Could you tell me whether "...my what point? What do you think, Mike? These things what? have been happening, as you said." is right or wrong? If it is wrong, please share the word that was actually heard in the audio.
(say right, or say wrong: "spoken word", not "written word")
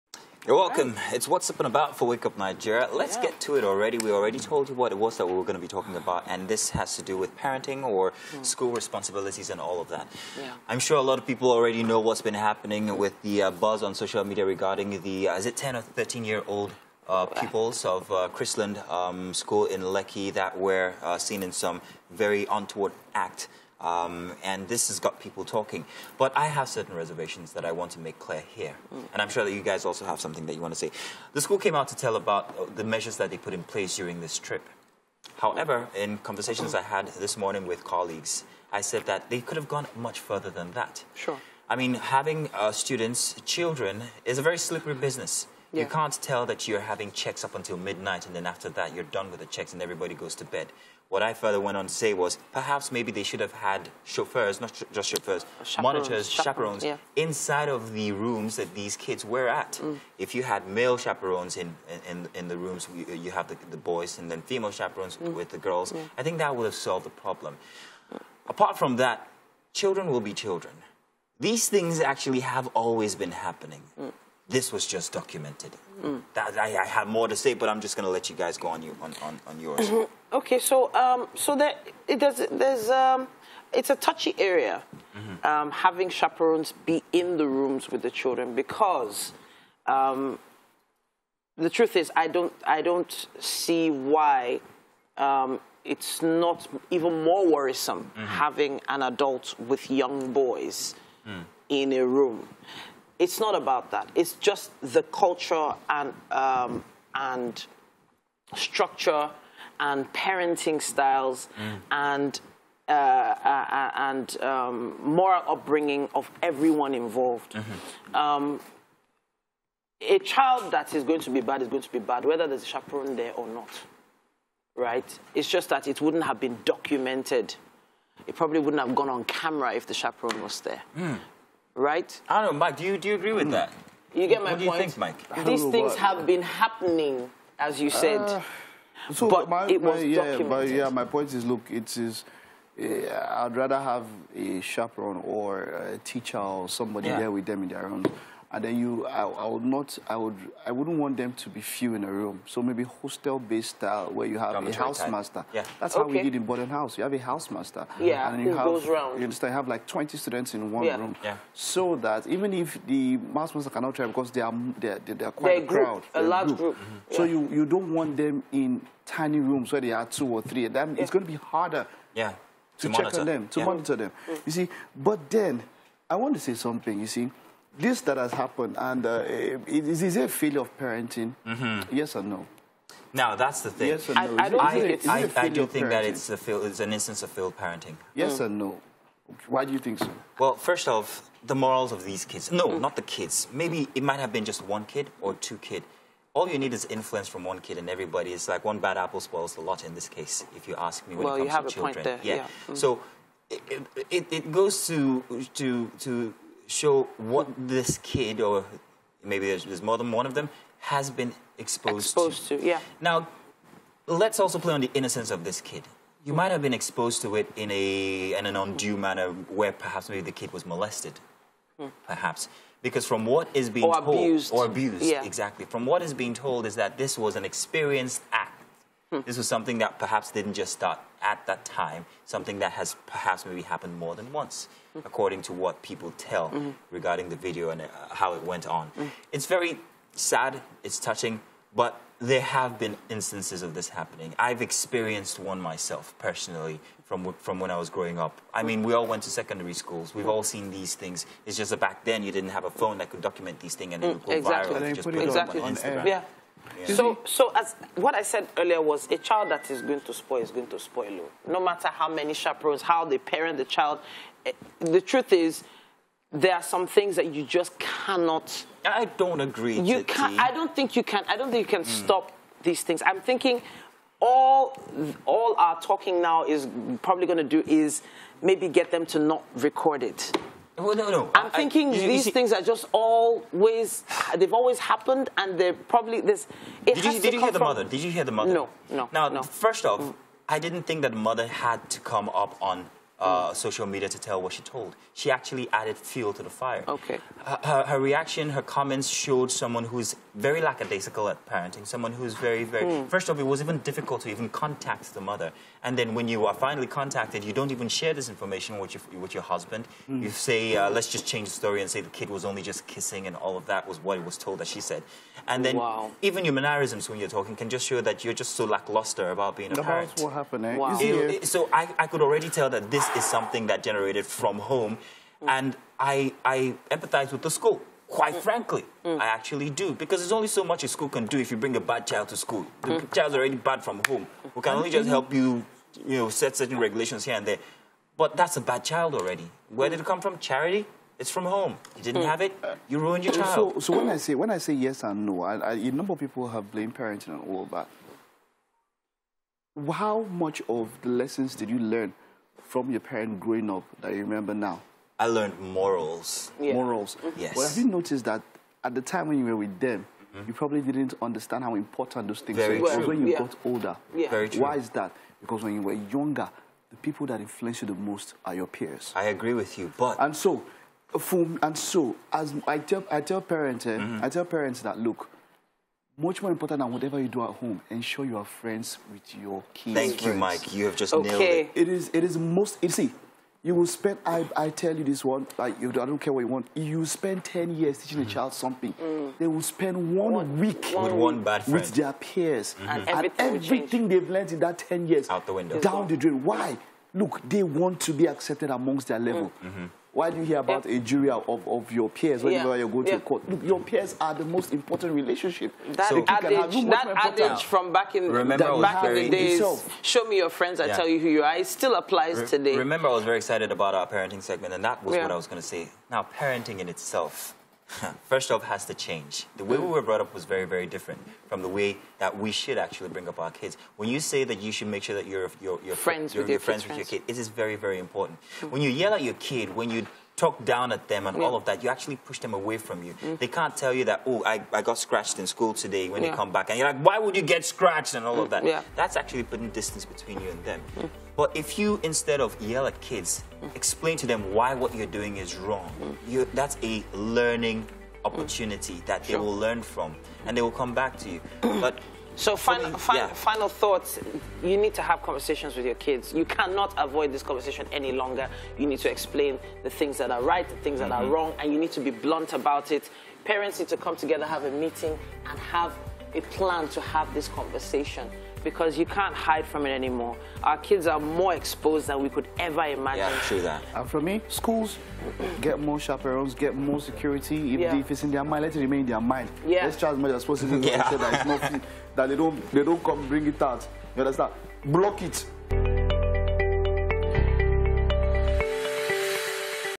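right.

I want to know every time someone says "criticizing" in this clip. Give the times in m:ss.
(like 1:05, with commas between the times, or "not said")
not said.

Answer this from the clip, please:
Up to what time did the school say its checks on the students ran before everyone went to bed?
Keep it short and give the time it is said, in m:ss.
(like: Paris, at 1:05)
Midnight, at 0:47.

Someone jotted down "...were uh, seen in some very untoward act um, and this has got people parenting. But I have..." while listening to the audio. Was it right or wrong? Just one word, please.
wrong.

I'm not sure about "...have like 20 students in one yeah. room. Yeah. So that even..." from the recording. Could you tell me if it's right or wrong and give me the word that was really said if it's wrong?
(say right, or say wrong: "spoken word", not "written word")
right.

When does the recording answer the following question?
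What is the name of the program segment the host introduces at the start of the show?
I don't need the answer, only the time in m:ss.
0:01.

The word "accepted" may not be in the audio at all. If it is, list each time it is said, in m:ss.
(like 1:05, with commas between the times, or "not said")
6:38.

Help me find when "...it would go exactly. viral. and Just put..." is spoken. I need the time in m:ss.
4:14.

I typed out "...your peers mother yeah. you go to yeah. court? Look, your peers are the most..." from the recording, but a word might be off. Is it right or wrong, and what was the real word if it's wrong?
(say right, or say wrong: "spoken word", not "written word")
wrong: "whenever", not "mother".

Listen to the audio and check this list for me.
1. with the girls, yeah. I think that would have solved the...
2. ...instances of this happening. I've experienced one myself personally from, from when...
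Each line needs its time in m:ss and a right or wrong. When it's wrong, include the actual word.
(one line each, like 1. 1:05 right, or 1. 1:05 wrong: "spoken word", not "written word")
1. 1:05 right
2. 4:03 right.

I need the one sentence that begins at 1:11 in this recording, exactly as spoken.
These things actually have always been happening.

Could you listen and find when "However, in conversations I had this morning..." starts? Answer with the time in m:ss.
0:35.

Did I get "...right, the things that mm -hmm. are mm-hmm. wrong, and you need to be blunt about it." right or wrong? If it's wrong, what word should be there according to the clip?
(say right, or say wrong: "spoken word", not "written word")
right.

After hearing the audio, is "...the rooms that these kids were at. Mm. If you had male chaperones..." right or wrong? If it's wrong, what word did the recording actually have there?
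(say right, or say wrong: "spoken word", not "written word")
right.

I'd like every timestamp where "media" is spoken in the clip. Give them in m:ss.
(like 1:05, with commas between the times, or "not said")
0:14, 4:53.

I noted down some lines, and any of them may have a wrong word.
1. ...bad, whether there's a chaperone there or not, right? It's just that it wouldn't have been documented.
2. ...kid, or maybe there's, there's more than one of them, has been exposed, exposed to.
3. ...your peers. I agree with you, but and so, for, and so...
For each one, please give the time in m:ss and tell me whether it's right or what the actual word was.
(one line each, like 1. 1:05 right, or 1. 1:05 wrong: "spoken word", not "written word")
1. 2:02 right
2. 3:27 right
3. 6:08 right.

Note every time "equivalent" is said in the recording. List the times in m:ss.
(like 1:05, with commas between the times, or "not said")
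not said.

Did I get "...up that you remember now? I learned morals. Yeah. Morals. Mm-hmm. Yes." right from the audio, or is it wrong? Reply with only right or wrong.
right.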